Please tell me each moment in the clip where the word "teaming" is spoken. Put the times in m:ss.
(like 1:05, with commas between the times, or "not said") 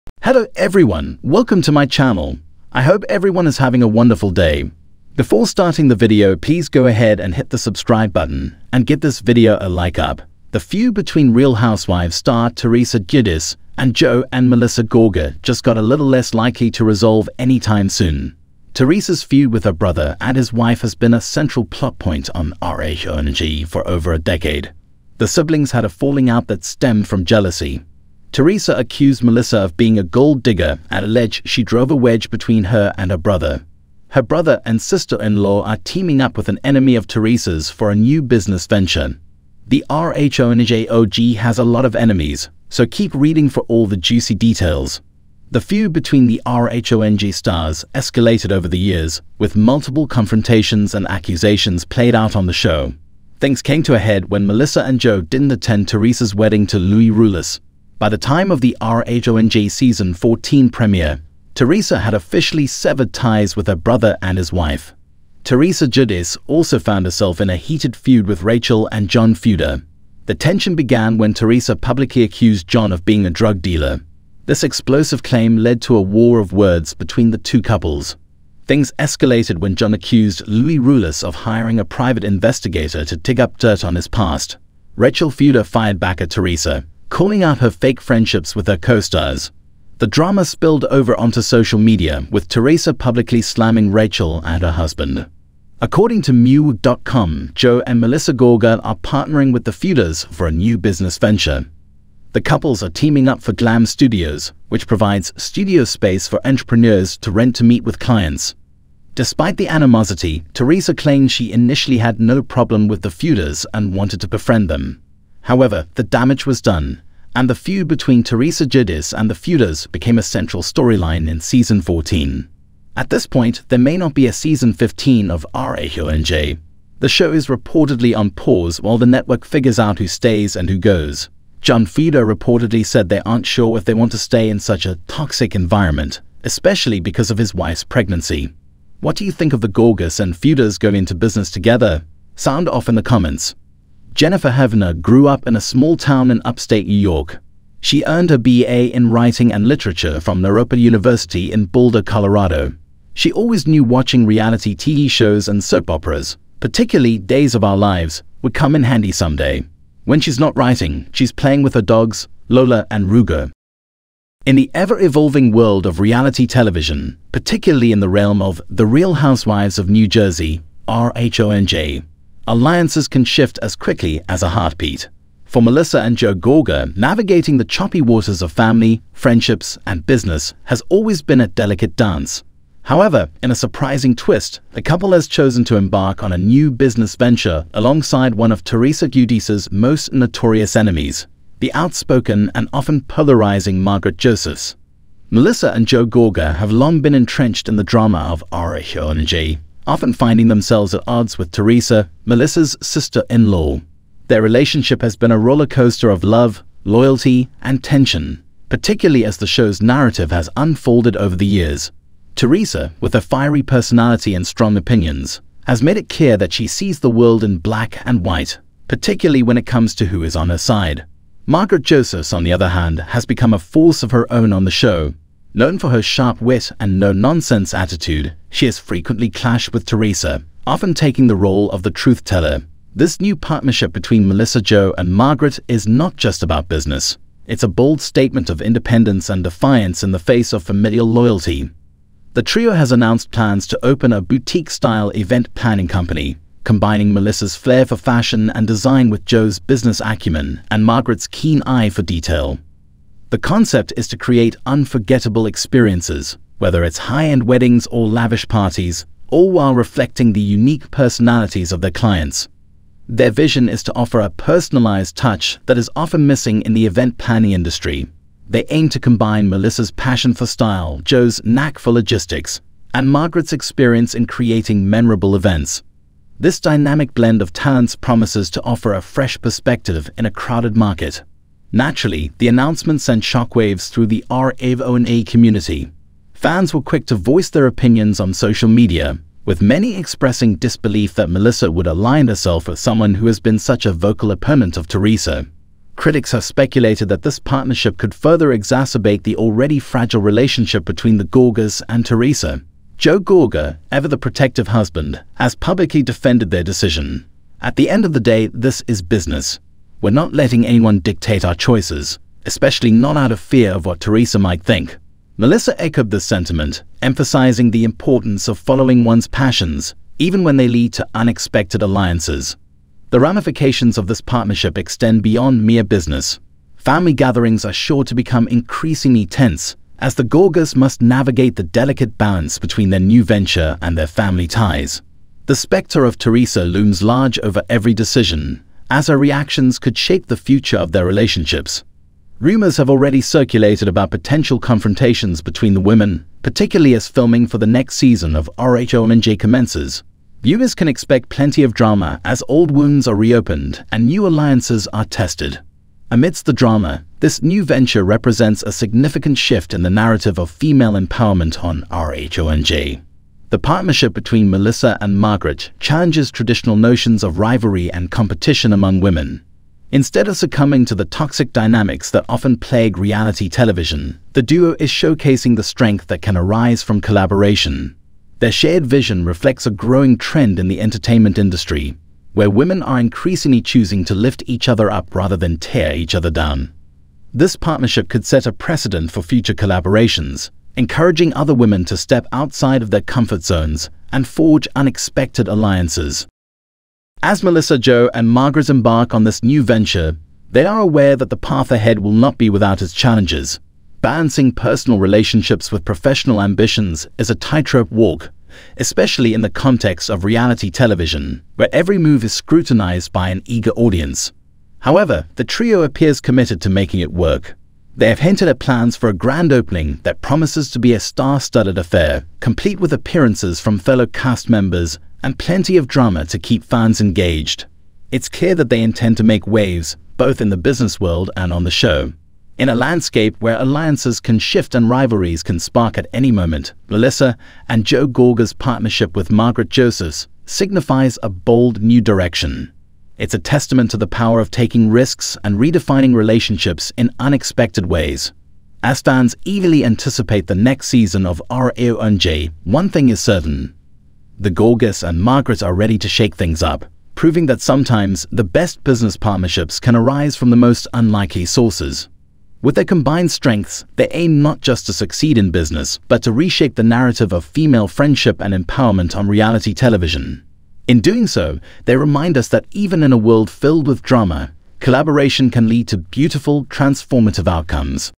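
0:35, 1:42.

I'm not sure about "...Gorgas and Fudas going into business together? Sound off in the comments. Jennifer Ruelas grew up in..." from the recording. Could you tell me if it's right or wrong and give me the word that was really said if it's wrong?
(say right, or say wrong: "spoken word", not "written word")
wrong: "Hevner", not "Ruelas".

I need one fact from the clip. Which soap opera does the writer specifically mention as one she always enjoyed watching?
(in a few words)
Days of Our Lives.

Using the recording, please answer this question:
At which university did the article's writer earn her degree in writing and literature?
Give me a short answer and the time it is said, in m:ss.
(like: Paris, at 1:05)
Naropa University, at 2:30.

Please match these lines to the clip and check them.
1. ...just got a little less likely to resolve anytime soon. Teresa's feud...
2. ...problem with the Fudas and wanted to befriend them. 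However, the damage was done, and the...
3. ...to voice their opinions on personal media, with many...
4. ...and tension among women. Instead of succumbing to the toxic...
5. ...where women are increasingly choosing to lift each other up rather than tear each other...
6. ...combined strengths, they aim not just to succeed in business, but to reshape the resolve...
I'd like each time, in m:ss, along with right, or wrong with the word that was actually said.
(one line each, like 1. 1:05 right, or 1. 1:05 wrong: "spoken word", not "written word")
1. 0:15 right
2. 1:52 right
3. 4:47 wrong: "social", not "personal"
4. 6:07 wrong: "competition", not "tension"
5. 6:22 right
6. 7:42 wrong: "narrative", not "resolve".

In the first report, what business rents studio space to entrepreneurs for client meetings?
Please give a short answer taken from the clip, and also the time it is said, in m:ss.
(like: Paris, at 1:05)
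Glam Studios, at 1:43.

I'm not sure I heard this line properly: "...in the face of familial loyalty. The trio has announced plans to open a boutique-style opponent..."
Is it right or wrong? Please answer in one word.
wrong.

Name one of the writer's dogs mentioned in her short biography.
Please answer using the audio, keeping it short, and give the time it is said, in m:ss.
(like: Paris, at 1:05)
Lola, at 2:42.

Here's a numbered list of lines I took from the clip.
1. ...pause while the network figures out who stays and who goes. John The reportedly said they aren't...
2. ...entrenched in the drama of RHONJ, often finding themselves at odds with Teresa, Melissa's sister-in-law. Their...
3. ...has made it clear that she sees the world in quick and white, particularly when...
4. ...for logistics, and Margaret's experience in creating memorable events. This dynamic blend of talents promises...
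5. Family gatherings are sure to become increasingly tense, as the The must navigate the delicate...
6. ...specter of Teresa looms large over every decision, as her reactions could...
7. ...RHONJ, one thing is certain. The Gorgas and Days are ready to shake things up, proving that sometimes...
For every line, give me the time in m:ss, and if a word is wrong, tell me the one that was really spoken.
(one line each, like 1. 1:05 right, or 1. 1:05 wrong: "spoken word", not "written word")
1. 2:08 wrong: "Fuda", not "The"
2. 3:17 right
3. 3:35 wrong: "black", not "quick"
4. 4:31 right
5. 5:26 wrong: "Gorgas", not "The"
6. 5:35 right
7. 7:31 wrong: "Margaret", not "Days".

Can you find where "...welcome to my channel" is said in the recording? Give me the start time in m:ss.
0:01.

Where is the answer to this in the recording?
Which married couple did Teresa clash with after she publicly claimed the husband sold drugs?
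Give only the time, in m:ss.
1:08.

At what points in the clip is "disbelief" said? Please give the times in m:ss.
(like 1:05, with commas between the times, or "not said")
4:50.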